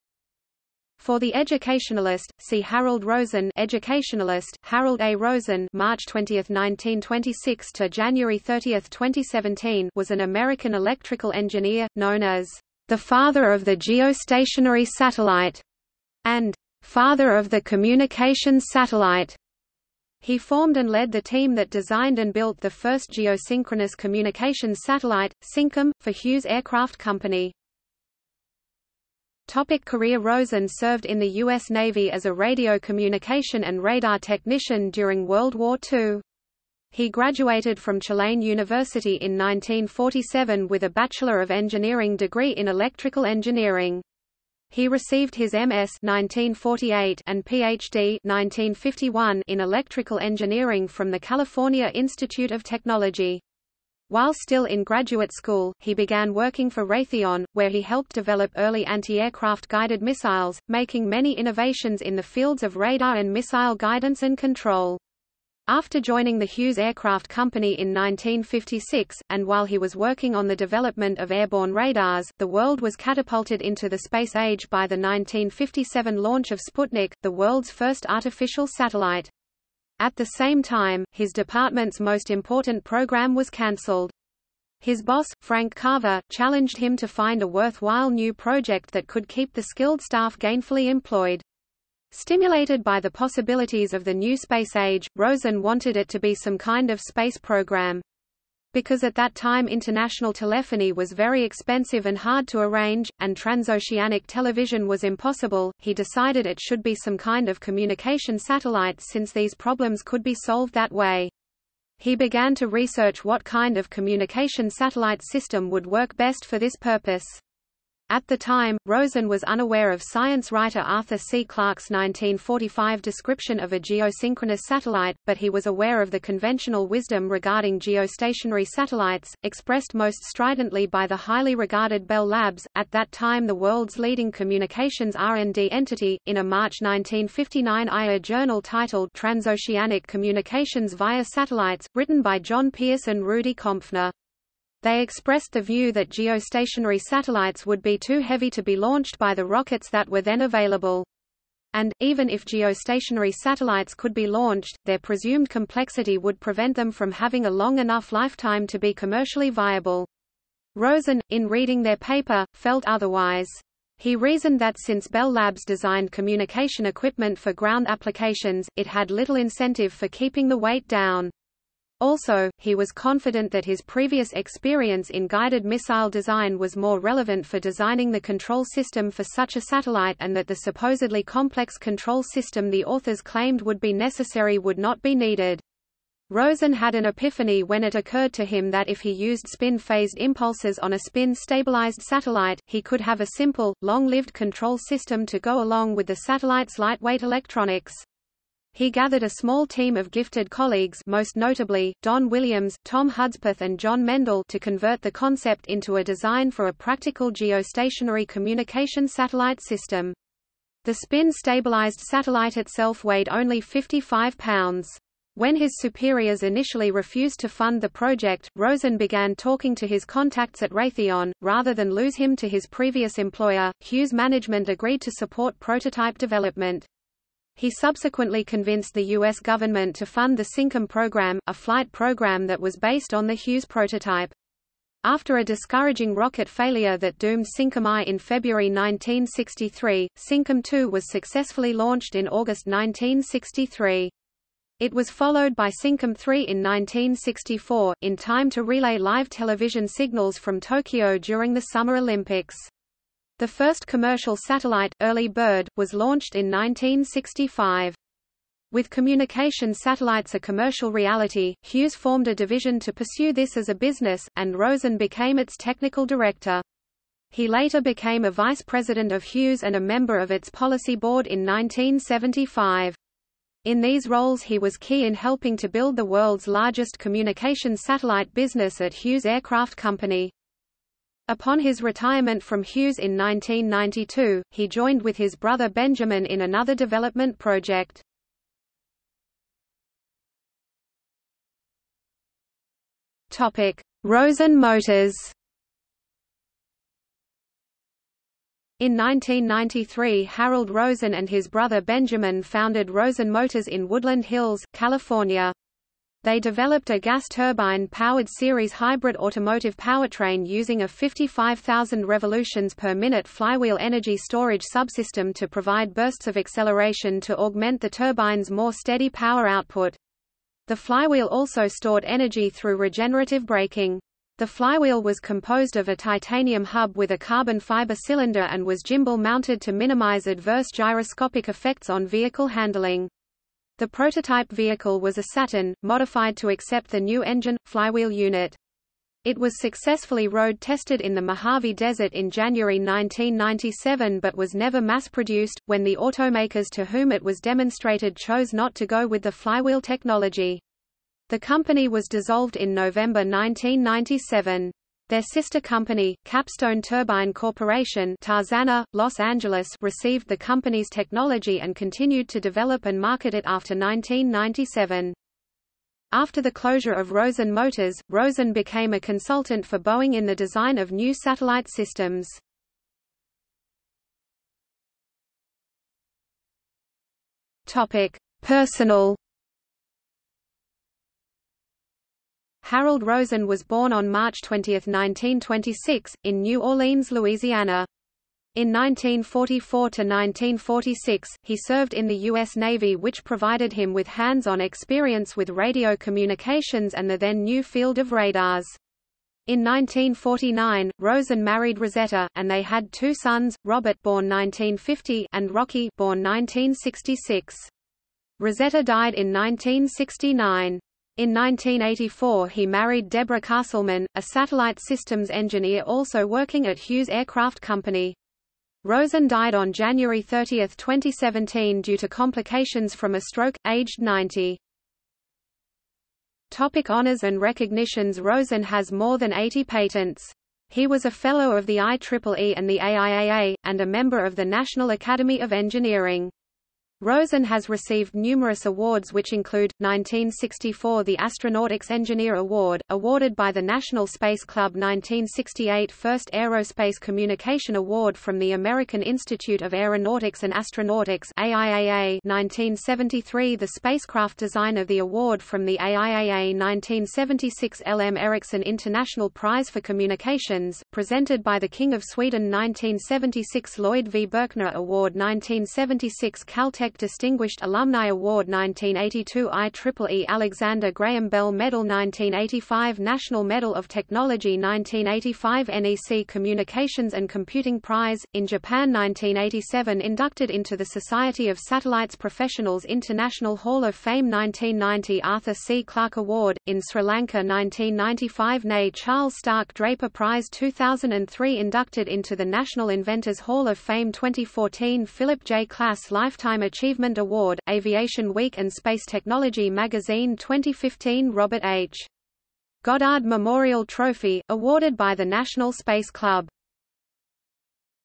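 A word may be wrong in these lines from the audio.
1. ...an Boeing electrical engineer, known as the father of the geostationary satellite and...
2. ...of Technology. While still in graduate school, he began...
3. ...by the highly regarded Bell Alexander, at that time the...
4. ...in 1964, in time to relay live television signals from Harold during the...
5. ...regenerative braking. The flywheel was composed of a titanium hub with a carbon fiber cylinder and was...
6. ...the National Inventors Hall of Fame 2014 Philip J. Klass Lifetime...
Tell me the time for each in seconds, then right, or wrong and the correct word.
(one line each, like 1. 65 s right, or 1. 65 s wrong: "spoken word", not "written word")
1. 10 s wrong: "American", not "Boeing"
2. 52 s right
3. 130 s wrong: "Labs", not "Alexander"
4. 246 s wrong: "Tokyo", not "Harold"
5. 322 s right
6. 492 s right.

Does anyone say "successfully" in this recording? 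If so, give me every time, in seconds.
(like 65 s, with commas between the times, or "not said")
241 s, 339 s.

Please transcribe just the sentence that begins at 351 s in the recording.
The company was dissolved in November 1997.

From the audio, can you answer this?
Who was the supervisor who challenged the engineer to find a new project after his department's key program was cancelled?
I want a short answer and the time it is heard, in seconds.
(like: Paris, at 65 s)
Frank Carver, at 85 s.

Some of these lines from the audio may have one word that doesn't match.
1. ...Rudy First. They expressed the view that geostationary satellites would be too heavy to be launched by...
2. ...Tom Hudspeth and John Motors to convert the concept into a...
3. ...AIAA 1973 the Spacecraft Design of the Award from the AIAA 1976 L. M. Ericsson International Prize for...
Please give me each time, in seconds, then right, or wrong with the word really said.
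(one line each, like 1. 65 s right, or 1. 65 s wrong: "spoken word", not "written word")
1. 143 s wrong: "Kompfner", not "First"
2. 202 s wrong: "Mendel", not "Motors"
3. 451 s right.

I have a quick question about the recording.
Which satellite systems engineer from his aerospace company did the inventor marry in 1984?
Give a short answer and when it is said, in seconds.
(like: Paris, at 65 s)
Deborah Castleman, at 413 s.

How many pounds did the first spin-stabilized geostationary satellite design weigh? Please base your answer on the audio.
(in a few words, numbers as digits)
55.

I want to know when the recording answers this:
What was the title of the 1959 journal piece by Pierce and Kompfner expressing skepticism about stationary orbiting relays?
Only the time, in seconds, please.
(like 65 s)
139 s.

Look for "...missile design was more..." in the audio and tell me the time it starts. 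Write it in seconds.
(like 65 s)
175 s.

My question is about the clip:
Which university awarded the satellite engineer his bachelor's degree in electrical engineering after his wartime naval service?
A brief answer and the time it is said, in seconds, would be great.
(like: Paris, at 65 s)
Tulane University, at 37 s.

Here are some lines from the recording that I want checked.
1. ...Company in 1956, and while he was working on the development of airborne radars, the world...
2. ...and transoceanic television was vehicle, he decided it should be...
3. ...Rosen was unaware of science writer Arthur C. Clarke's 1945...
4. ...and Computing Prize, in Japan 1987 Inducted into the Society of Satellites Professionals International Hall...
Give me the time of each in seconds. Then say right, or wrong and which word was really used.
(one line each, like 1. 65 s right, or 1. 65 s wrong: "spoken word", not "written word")
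1. 67 s right
2. 103 s wrong: "impossible", not "vehicle"
3. 118 s right
4. 477 s right.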